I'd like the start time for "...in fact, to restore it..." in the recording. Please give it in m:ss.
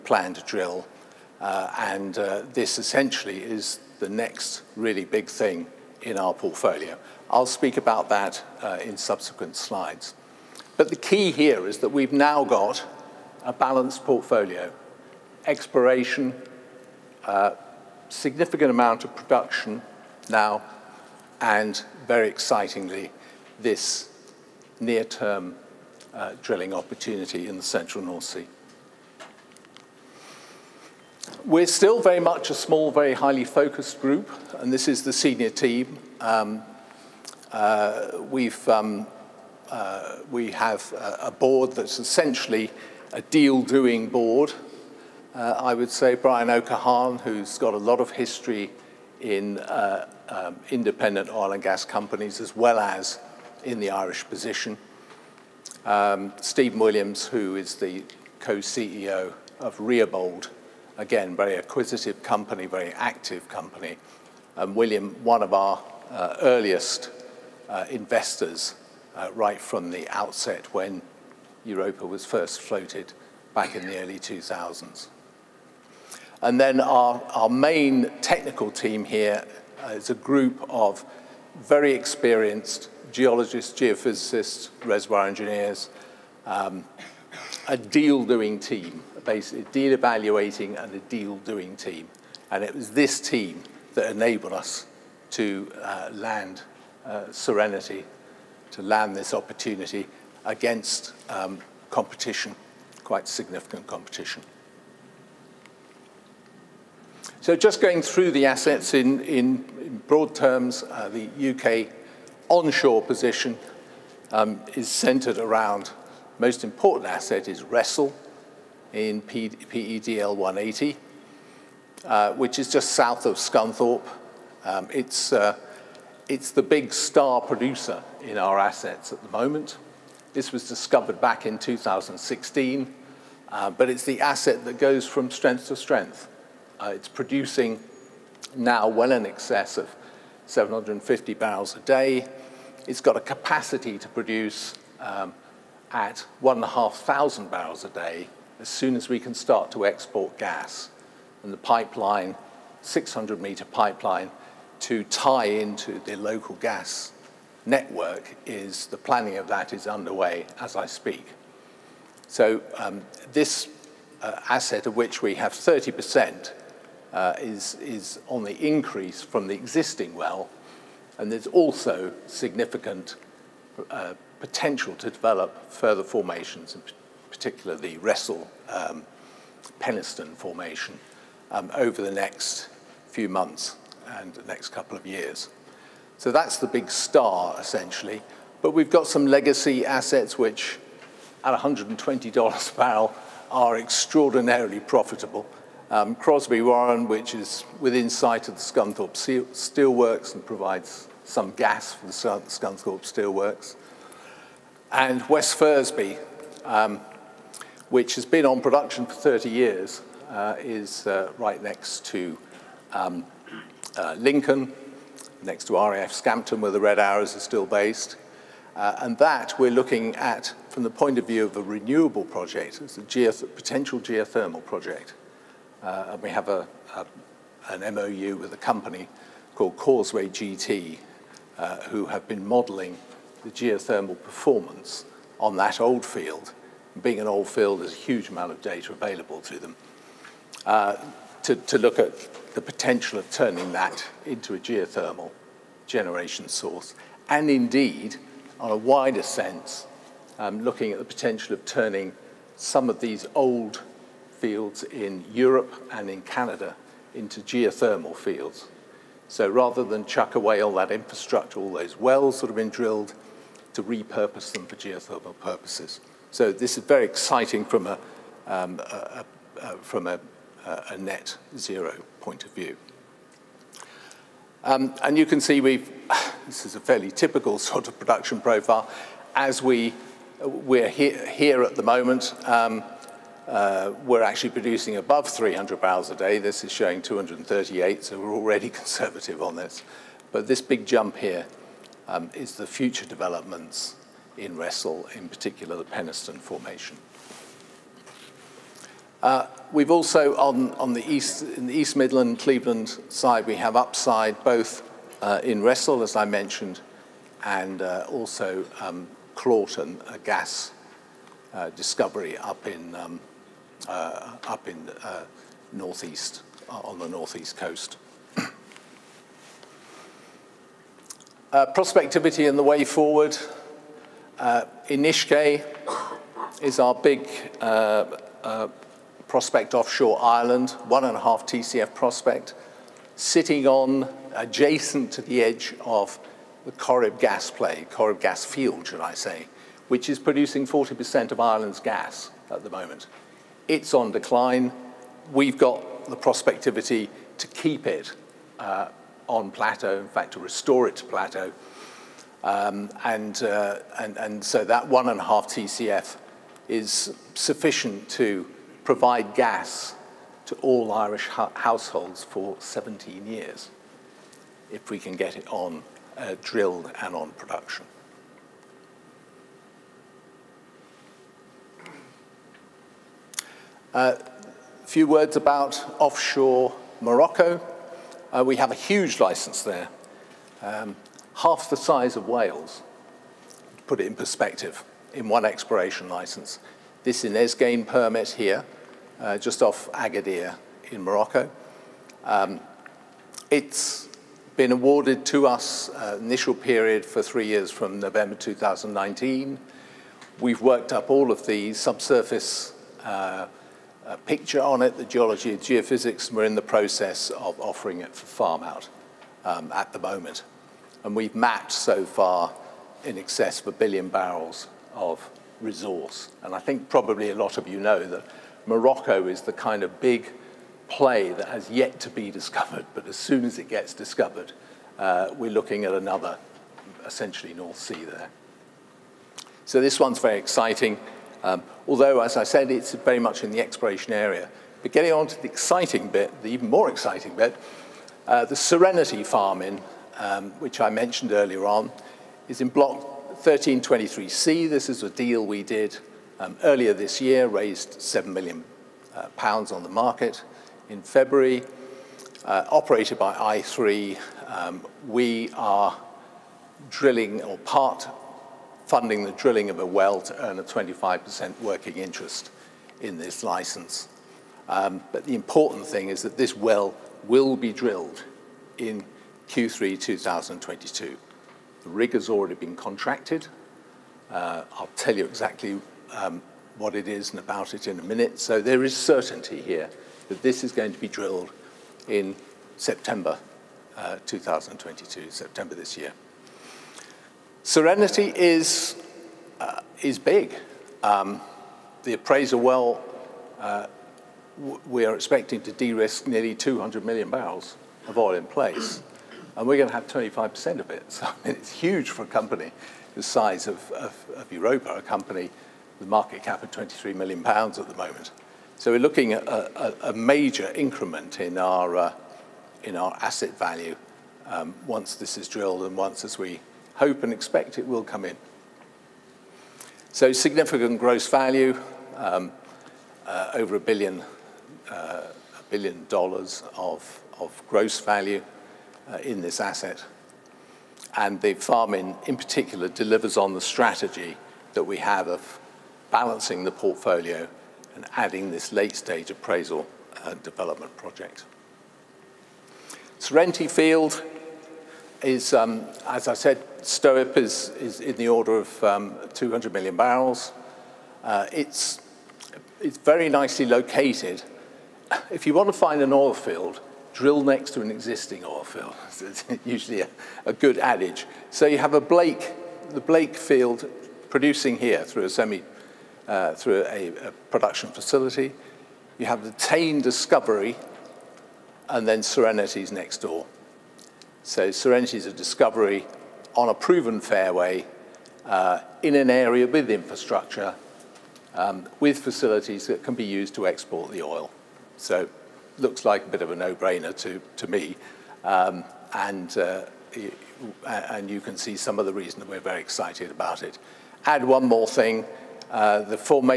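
5:49.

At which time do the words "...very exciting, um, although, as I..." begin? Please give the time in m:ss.
7:10.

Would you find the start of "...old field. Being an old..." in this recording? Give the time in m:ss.
3:55.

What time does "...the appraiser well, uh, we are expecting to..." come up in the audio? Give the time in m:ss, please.
8:12.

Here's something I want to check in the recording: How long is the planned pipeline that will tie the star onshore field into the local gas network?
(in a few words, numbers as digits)
600 meters.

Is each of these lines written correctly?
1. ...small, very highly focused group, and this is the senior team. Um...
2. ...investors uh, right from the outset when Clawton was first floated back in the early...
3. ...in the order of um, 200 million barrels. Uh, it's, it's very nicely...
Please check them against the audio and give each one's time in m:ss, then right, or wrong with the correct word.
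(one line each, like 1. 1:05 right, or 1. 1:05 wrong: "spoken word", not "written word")
1. 0:32 right
2. 1:07 wrong: "Europa", not "Clawton"
3. 9:08 right.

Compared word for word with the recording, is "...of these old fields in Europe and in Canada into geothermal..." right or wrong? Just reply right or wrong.
right.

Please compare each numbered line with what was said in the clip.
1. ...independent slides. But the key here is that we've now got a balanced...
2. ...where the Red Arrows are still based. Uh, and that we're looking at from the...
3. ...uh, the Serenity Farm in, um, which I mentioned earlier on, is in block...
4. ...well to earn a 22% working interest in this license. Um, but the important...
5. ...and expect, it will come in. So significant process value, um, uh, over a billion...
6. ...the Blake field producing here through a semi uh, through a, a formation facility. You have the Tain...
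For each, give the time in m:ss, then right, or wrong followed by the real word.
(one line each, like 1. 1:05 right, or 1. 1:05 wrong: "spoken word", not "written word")
1. 0:08 wrong: "subsequent", not "independent"
2. 3:36 right
3. 7:18 right
4. 7:39 wrong: "25", not "22"
5. 8:37 wrong: "gross", not "process"
6. 9:22 wrong: "production", not "formation".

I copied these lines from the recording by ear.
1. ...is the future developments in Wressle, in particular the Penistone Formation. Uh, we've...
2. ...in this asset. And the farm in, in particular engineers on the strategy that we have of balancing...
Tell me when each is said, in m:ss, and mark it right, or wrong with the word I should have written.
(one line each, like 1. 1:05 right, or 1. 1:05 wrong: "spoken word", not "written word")
1. 4:52 right
2. 8:49 wrong: "delivers", not "engineers".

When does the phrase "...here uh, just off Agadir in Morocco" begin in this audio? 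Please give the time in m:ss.
6:28.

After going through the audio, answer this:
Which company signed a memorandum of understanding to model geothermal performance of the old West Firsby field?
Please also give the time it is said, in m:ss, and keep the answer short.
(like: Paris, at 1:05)
Causeway GT, at 3:49.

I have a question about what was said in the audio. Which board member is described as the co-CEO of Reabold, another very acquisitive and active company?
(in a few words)
Steve Williams.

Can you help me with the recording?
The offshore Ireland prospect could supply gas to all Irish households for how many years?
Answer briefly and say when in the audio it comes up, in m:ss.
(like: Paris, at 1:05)
17, at 6:02.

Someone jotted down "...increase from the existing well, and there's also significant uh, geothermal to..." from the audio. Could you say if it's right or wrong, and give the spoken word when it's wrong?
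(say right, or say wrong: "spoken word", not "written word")
wrong: "potential", not "geothermal".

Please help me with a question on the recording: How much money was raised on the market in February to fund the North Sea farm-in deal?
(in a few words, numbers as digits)
7 million pounds.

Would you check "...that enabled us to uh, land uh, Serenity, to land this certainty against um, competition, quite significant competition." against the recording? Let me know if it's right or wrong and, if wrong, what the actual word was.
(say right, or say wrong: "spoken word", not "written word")
wrong: "opportunity", not "certainty".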